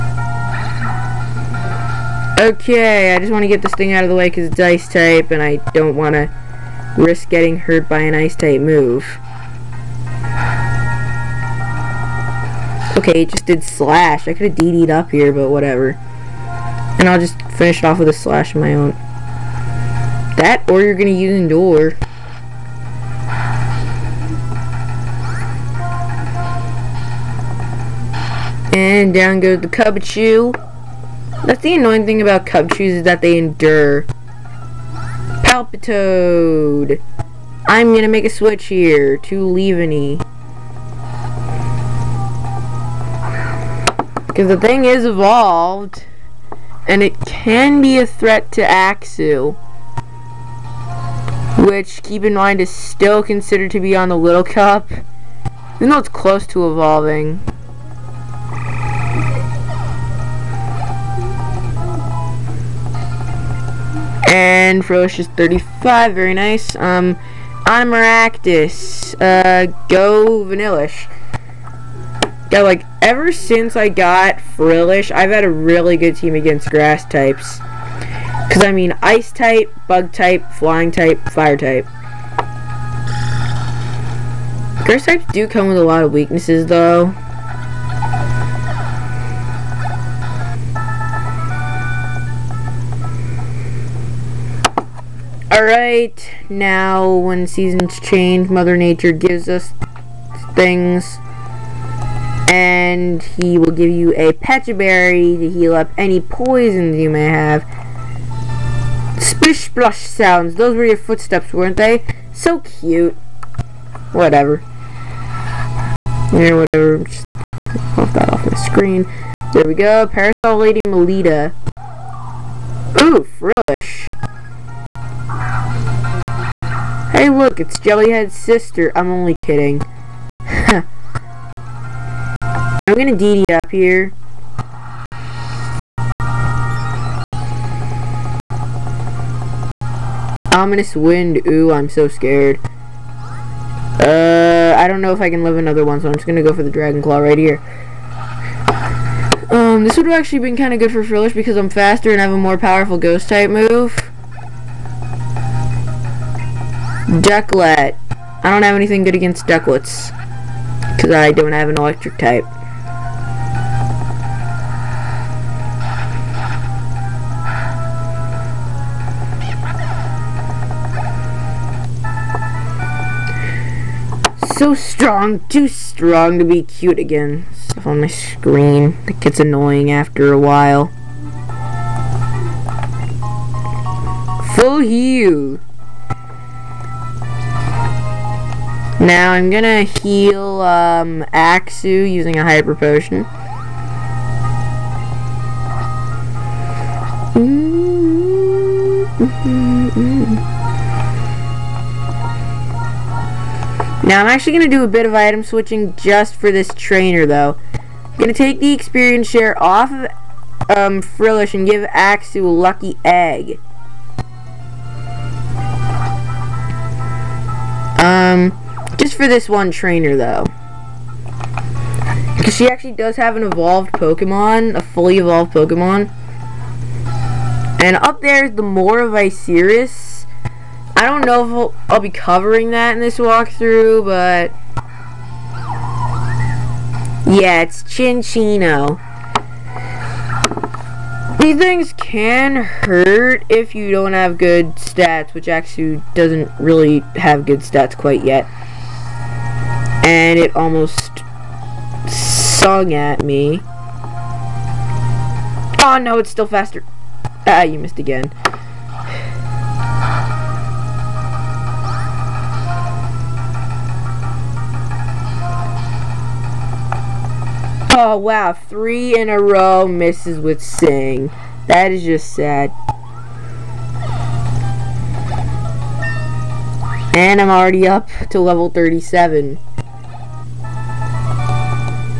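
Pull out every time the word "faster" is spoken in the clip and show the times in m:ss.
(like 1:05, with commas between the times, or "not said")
2:31, 4:16.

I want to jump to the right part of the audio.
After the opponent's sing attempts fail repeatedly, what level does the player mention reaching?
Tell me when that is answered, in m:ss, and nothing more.
4:38.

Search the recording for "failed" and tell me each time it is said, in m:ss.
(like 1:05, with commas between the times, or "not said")
not said.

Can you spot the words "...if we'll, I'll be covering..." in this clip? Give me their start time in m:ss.
3:51.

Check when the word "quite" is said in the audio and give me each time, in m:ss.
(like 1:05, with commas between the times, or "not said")
4:07.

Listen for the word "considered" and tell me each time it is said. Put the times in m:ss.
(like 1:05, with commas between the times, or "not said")
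0:53.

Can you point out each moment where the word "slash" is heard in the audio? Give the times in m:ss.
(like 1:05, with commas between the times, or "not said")
0:13, 0:18.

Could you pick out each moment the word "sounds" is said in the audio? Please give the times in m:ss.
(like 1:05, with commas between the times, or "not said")
1:50.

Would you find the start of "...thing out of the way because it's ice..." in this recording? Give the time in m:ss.
0:03.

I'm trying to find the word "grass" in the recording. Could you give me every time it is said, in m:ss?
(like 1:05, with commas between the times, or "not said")
1:16, 1:24.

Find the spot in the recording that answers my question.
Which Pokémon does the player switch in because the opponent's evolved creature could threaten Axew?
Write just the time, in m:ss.
0:39.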